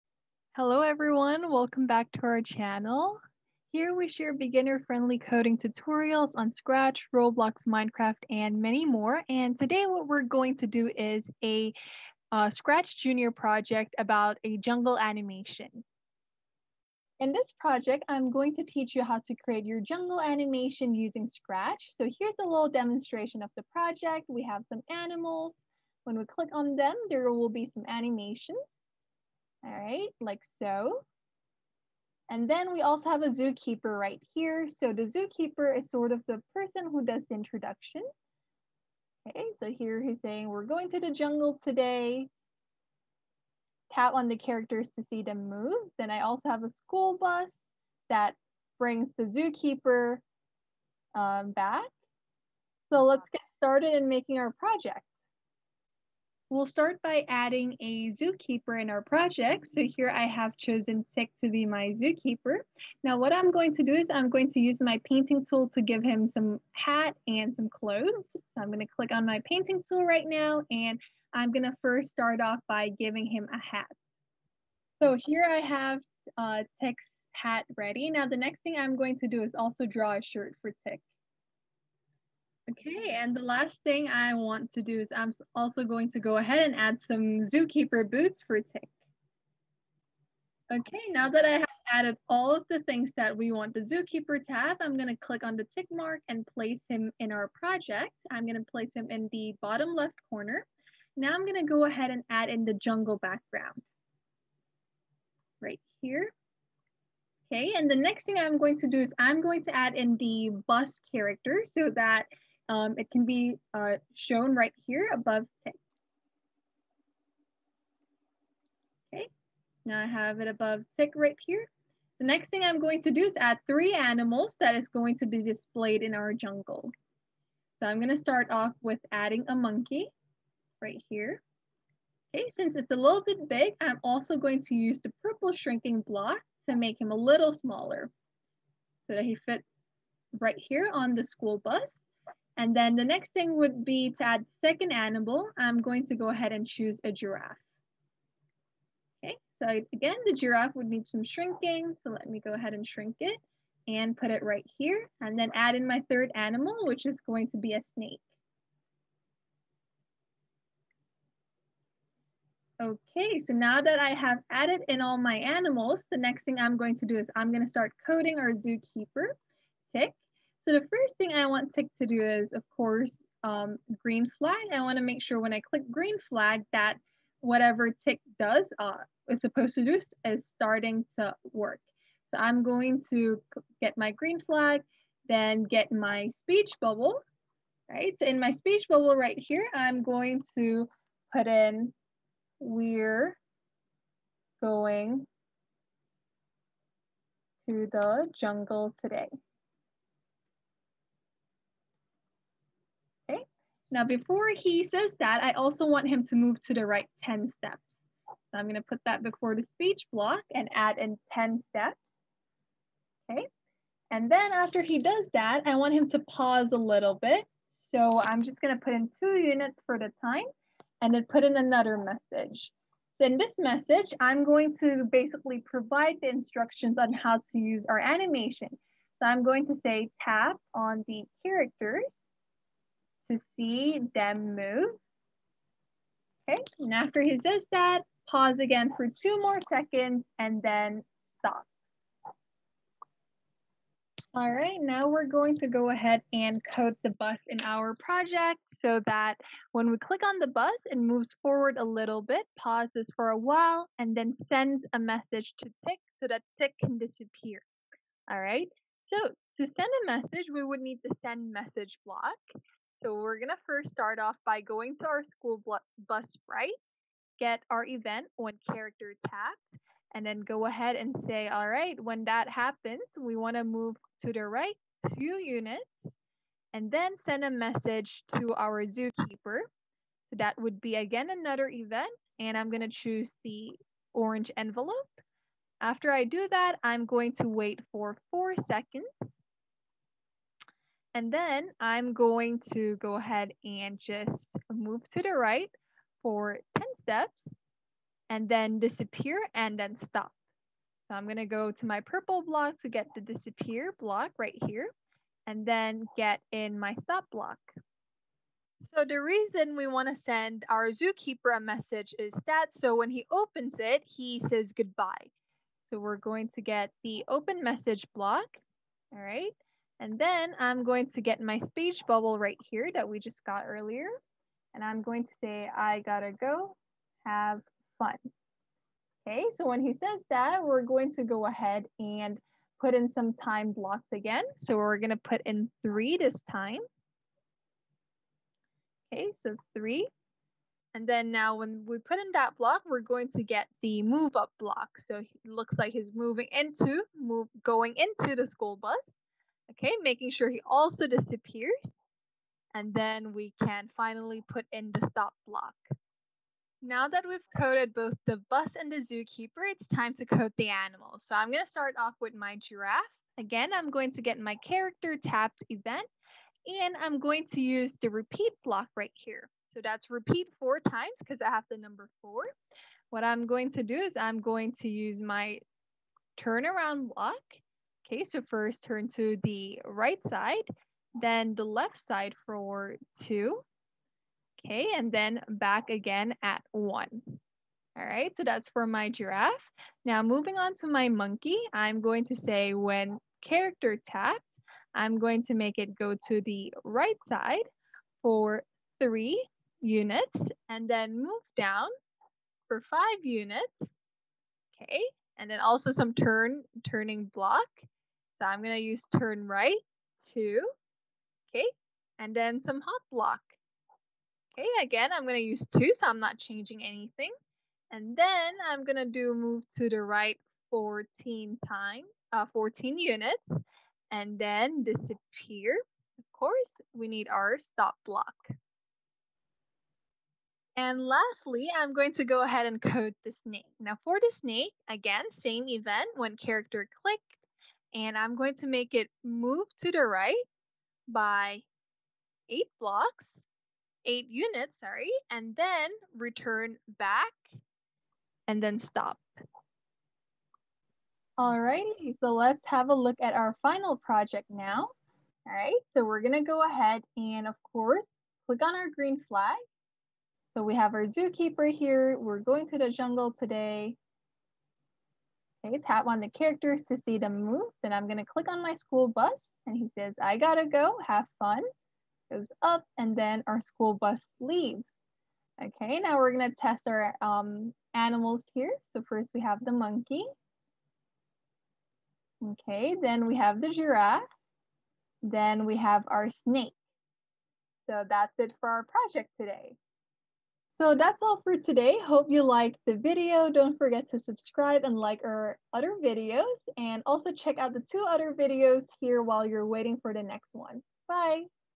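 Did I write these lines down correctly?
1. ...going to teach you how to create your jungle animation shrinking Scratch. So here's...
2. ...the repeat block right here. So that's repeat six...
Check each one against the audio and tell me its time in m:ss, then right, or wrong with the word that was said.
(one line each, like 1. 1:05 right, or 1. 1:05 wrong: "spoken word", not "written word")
1. 0:18 wrong: "using", not "shrinking"
2. 6:08 wrong: "four", not "six".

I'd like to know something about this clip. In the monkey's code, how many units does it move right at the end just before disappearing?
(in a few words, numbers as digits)
14.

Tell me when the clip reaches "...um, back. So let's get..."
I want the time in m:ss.
0:51.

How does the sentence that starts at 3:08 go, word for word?
So in my speech bubble right here, I'm going to put in we're going to the jungle today.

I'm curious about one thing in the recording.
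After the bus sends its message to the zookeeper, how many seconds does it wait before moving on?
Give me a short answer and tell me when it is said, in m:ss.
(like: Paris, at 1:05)
4, at 4:48.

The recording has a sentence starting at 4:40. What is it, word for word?
So that would be again another event and I'm going to choose the orange envelope.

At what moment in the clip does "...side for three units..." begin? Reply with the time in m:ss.
6:37.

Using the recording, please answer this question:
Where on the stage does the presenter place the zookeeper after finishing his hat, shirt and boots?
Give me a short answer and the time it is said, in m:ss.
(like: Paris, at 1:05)
bottom left corner, at 1:39.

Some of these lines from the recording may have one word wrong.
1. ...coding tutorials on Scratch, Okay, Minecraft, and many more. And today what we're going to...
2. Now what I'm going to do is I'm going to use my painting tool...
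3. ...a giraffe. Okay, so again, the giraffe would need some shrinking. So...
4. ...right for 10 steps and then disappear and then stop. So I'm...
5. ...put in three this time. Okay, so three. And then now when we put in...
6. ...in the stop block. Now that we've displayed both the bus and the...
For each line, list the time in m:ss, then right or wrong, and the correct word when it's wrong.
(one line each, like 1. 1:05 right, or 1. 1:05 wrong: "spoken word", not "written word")
1. 0:05 wrong: "Roblox", not "Okay"
2. 1:03 right
3. 2:27 right
4. 4:55 right
5. 5:35 right
6. 5:54 wrong: "coded", not "displayed".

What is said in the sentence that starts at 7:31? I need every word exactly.
Alrighty, so let's have a look at our final project now.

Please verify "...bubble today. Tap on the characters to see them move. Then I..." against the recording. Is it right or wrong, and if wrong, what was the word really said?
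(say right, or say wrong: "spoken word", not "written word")
wrong: "jungle", not "bubble".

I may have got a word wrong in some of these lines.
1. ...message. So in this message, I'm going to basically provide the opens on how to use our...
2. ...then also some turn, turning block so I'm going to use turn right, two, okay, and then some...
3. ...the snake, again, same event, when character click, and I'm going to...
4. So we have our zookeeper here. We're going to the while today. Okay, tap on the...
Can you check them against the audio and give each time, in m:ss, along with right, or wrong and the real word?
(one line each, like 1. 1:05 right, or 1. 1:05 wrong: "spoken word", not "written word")
1. 3:41 wrong: "instructions", not "opens"
2. 6:45 right
3. 7:14 right
4. 7:40 wrong: "jungle", not "while".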